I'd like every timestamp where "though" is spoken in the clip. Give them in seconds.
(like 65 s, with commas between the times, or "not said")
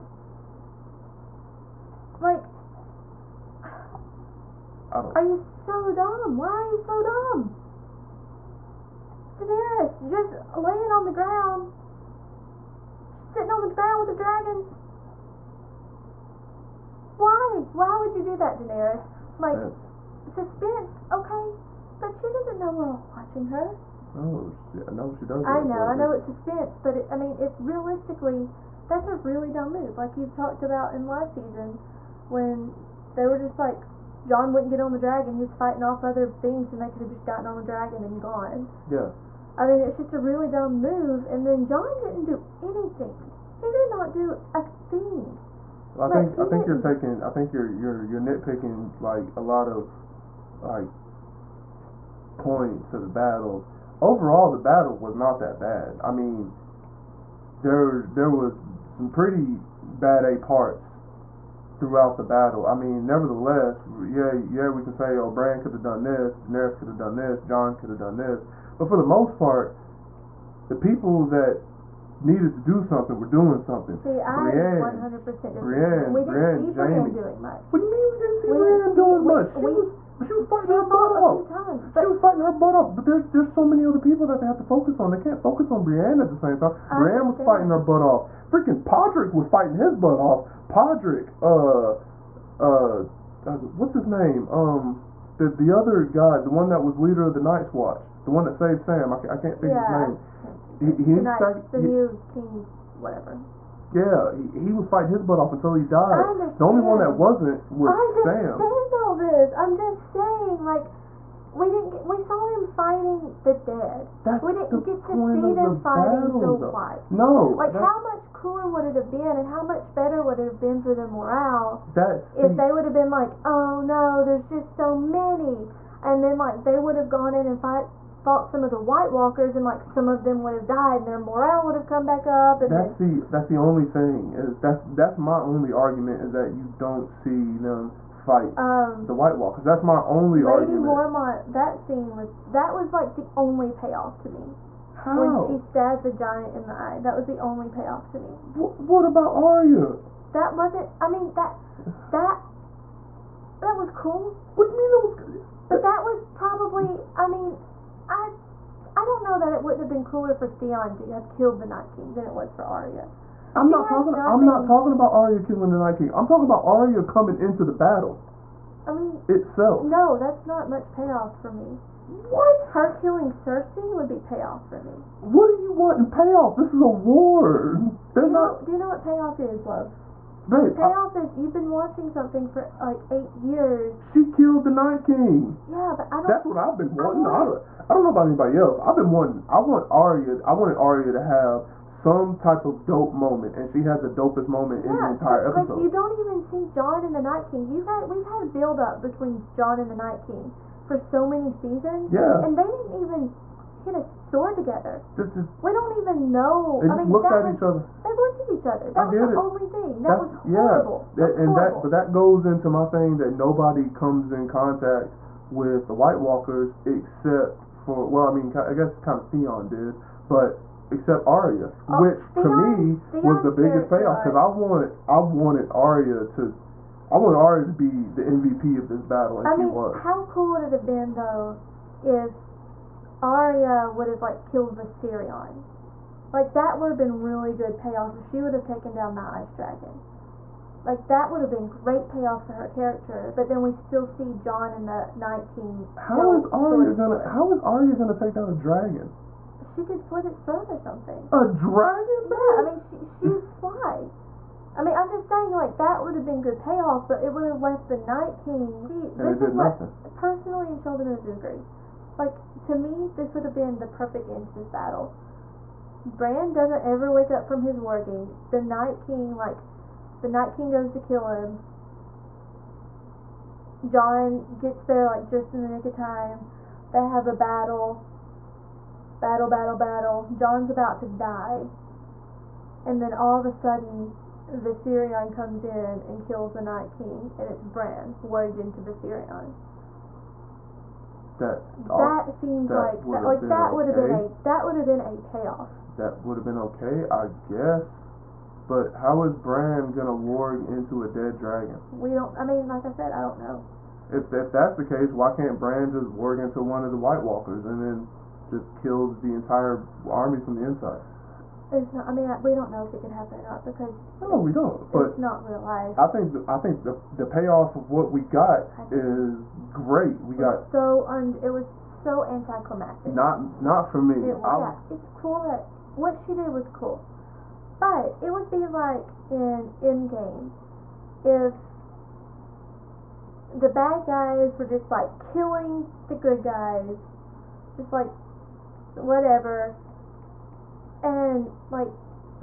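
116 s, 231 s.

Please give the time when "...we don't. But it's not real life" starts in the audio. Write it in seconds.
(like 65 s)
314 s.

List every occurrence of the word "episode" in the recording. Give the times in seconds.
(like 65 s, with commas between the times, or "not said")
195 s.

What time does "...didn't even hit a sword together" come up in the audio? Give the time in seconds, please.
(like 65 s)
202 s.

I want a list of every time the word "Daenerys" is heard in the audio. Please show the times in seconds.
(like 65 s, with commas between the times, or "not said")
9 s, 18 s, 66 s.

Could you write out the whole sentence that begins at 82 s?
But there's there's so many other people that they have to focus on.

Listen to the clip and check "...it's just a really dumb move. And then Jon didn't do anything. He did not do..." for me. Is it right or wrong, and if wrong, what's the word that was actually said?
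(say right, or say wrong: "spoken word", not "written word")
right.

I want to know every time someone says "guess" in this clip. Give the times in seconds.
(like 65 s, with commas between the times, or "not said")
218 s, 297 s.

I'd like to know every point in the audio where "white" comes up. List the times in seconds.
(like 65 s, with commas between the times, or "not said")
116 s, 128 s, 139 s, 215 s, 306 s.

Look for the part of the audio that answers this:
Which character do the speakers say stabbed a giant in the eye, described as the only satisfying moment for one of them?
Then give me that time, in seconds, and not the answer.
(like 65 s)
140 s.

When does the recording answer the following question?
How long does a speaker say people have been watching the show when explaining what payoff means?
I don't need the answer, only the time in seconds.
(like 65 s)
183 s.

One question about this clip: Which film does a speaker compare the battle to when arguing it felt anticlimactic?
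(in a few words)
Endgame.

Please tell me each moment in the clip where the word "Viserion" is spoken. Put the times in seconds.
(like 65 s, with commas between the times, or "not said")
234 s, 284 s, 288 s.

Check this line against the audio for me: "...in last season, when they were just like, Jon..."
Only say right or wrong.
right.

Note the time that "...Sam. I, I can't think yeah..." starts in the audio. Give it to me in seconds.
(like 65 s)
98 s.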